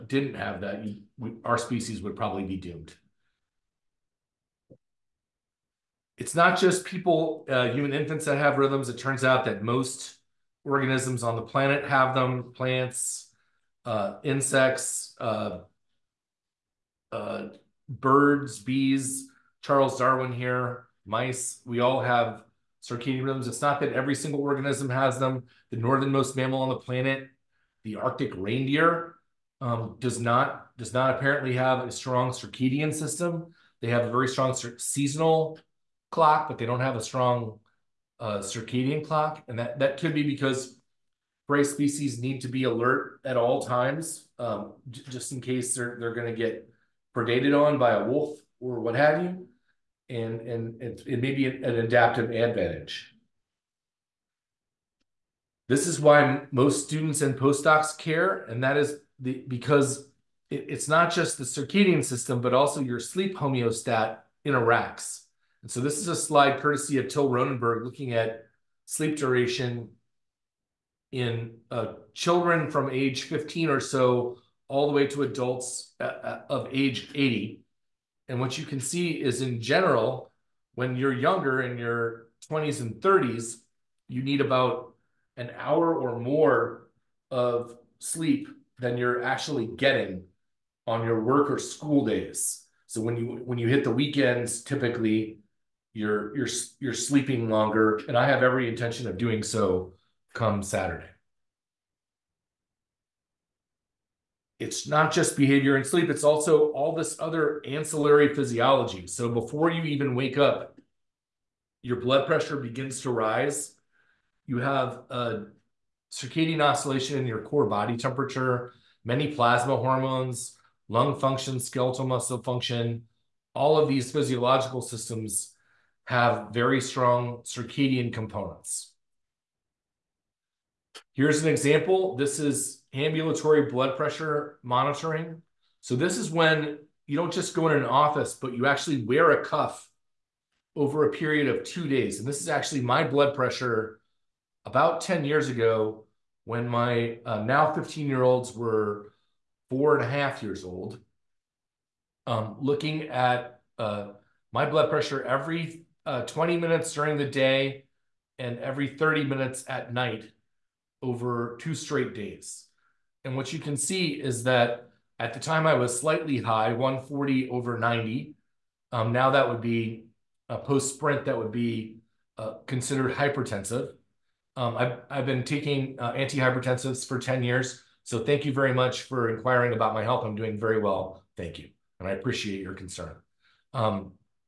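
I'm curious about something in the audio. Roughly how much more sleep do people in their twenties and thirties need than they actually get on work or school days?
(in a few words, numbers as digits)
About an hour.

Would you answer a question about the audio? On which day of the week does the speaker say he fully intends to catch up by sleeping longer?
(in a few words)
Saturday.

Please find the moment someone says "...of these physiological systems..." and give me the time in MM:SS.
02:03.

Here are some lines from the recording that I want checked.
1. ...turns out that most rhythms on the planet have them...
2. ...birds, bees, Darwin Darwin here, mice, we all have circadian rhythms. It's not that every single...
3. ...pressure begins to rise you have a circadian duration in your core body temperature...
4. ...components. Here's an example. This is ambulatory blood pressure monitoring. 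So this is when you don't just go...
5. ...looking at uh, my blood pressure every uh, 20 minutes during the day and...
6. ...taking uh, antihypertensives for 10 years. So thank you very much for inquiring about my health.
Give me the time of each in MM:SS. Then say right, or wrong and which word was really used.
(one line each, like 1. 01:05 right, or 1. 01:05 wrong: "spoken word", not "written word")
1. 00:08 wrong: "organisms", not "rhythms"
2. 00:17 wrong: "Charles", not "Darwin"
3. 01:52 wrong: "oscillation", not "duration"
4. 02:08 right
5. 02:32 right
6. 02:55 right.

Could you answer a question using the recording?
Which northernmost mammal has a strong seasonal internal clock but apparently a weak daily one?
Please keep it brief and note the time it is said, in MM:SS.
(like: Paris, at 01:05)
Arctic reindeer, at 00:27.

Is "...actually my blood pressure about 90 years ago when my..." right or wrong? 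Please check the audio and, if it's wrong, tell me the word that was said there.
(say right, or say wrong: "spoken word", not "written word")
wrong: "10", not "90".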